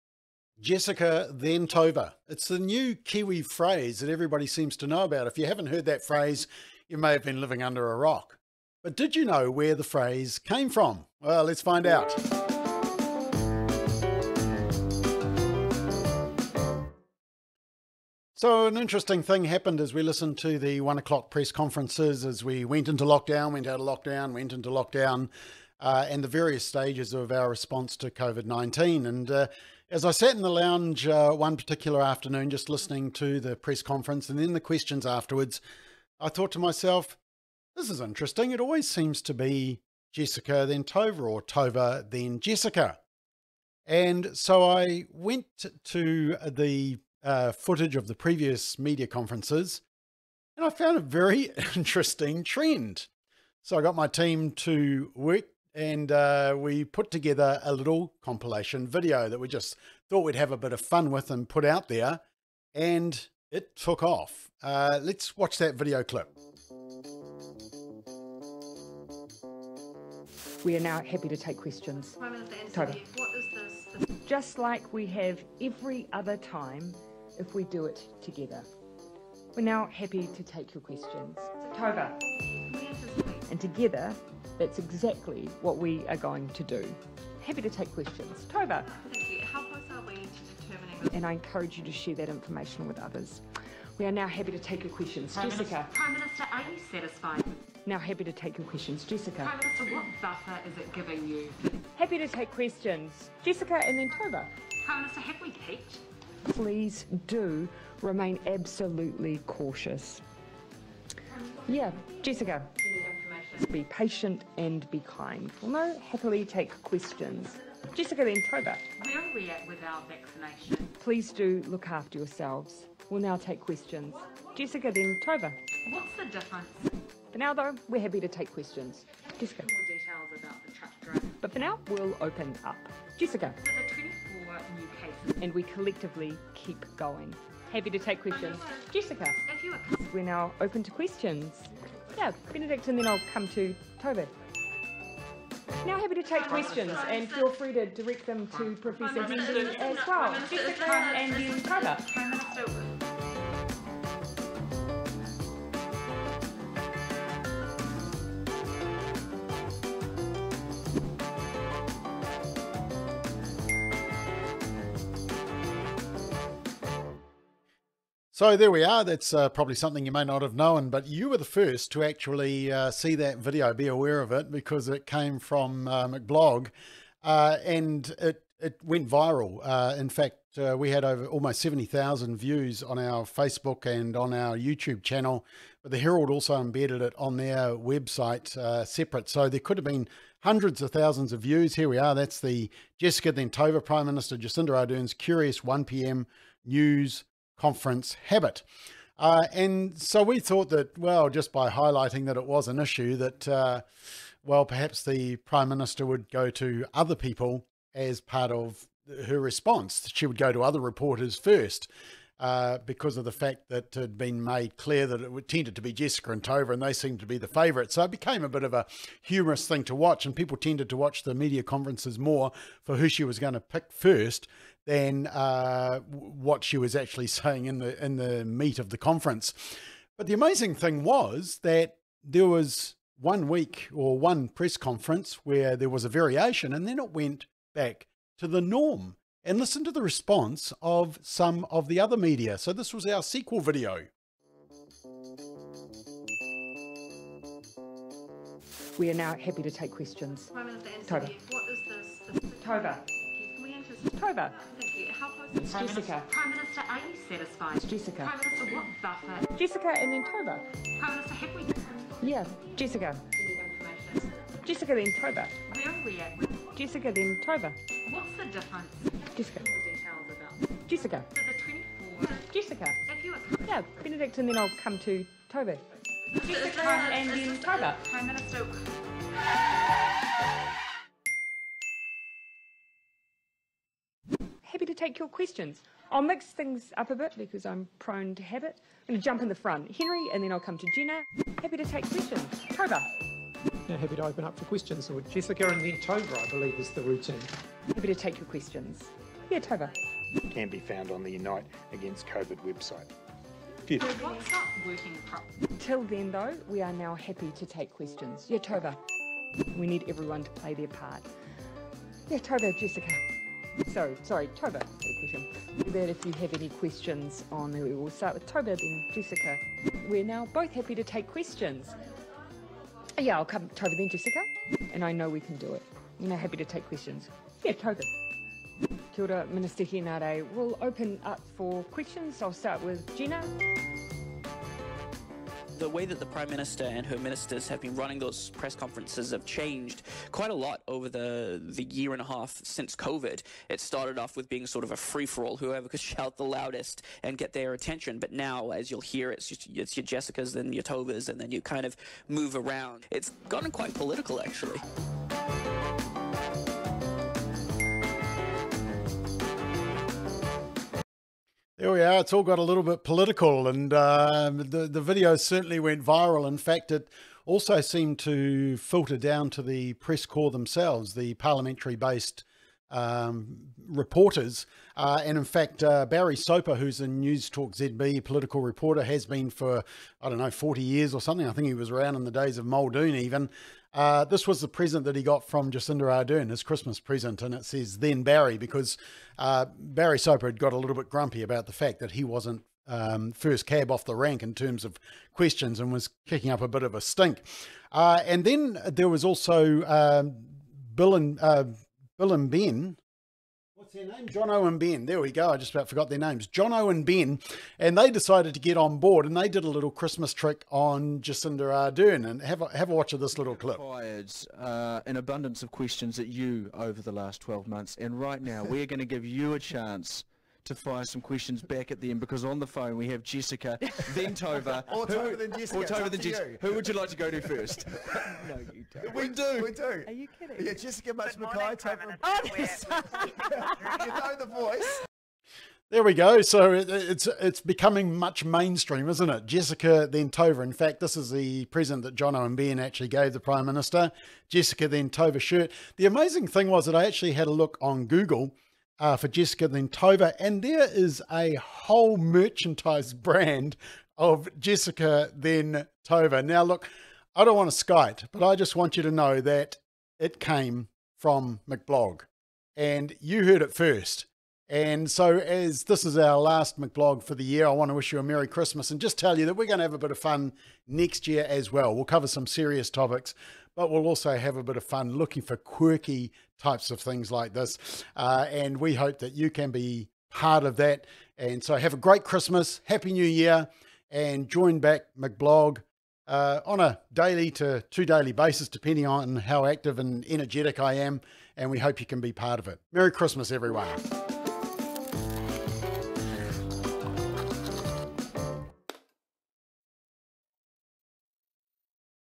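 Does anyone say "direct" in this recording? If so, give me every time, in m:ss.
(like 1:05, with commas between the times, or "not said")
2:27.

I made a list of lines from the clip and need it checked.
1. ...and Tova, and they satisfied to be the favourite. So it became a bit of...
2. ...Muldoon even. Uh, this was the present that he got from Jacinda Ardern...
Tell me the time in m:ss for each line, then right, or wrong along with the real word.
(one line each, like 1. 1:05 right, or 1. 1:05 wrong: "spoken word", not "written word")
1. 3:36 wrong: "seemed", not "satisfied"
2. 6:22 right.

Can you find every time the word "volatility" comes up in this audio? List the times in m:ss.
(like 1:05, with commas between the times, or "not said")
not said.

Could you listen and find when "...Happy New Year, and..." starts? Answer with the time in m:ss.
8:02.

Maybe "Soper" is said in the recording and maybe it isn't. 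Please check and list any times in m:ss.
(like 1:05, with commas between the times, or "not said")
6:16, 6:30.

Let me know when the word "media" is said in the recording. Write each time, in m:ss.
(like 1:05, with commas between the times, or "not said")
0:48, 3:41, 4:02.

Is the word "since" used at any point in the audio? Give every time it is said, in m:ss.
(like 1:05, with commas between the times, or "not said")
5:42.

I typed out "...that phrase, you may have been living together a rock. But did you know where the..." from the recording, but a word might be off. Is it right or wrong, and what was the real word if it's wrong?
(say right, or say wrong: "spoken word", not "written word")
wrong: "under", not "together".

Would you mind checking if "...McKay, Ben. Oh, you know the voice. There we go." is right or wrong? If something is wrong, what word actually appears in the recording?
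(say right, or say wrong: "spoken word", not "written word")
wrong: "Tova", not "Ben".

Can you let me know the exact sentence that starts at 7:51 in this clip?
We'll cover some serious topics but we'll also have a bit of fun looking for quirky types of things like this.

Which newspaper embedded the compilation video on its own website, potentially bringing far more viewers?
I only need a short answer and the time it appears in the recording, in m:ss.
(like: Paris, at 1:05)
The Herald, at 3:05.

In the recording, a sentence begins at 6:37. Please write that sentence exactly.
Uh, and then there was also um, Bill and uh, Bill and Ben their name?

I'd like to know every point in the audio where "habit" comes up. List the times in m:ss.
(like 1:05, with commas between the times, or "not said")
3:18, 4:48.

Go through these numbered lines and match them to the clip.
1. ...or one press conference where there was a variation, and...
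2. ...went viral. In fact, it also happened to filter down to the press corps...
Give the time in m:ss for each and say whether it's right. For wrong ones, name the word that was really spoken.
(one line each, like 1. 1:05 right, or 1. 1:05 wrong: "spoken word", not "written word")
1. 3:53 right
2. 6:05 wrong: "seemed", not "happened".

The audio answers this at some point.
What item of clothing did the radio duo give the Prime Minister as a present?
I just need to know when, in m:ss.
7:25.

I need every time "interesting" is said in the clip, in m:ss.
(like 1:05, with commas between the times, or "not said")
0:18, 0:37, 0:51.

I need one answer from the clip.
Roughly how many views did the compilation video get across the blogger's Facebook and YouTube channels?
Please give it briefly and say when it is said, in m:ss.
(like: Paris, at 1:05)
70,000, at 3:01.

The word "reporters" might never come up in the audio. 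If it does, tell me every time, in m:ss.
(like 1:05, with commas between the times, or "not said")
3:30, 6:13, 6:18.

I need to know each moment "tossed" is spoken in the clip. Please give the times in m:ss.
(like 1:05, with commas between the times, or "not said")
not said.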